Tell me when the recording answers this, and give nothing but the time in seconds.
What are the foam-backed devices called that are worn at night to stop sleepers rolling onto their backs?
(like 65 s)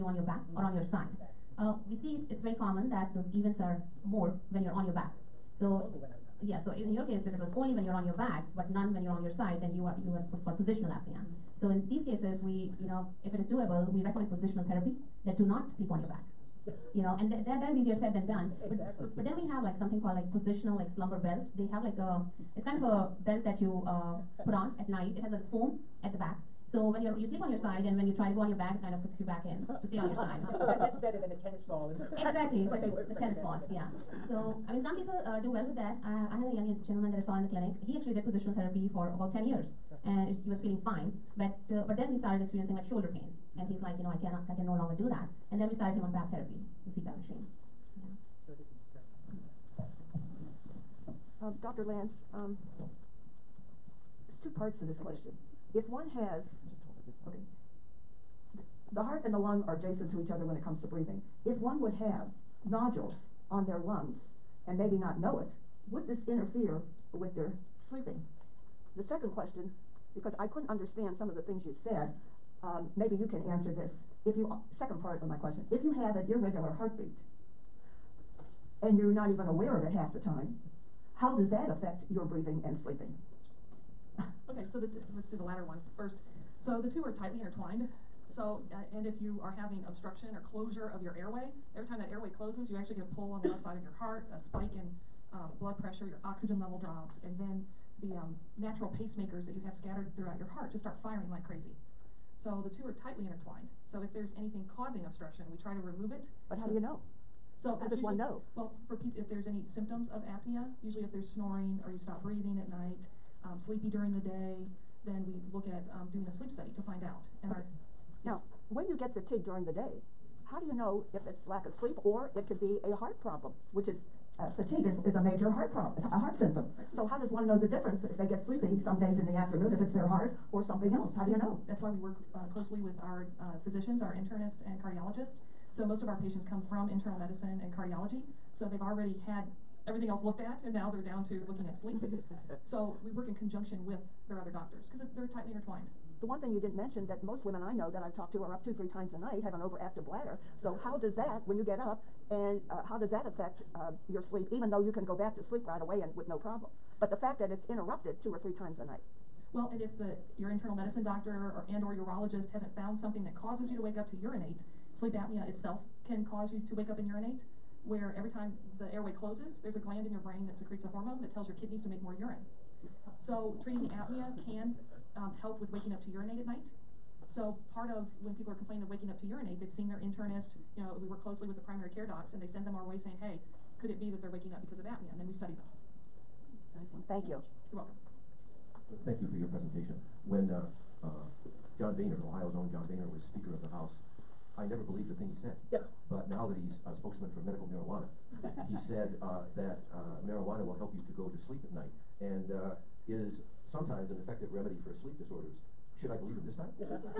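20 s.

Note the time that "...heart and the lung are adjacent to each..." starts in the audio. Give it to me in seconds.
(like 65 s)
59 s.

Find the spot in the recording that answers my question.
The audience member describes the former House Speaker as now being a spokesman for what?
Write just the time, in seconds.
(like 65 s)
197 s.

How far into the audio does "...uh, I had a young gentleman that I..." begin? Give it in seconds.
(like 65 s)
36 s.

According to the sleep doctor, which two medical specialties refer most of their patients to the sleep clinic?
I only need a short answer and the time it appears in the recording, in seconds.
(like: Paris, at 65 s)
internal medicine and cardiology, at 136 s.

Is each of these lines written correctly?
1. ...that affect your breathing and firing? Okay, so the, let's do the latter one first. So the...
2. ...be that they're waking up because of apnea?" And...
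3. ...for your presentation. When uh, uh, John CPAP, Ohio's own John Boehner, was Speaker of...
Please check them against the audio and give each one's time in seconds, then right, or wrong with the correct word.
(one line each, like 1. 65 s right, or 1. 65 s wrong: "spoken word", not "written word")
1. 81 s wrong: "sleeping", not "firing"
2. 183 s right
3. 189 s wrong: "Boehner", not "CPAP".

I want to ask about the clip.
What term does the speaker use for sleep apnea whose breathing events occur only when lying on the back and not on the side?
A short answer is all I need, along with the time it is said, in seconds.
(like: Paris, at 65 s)
positional apnea, at 10 s.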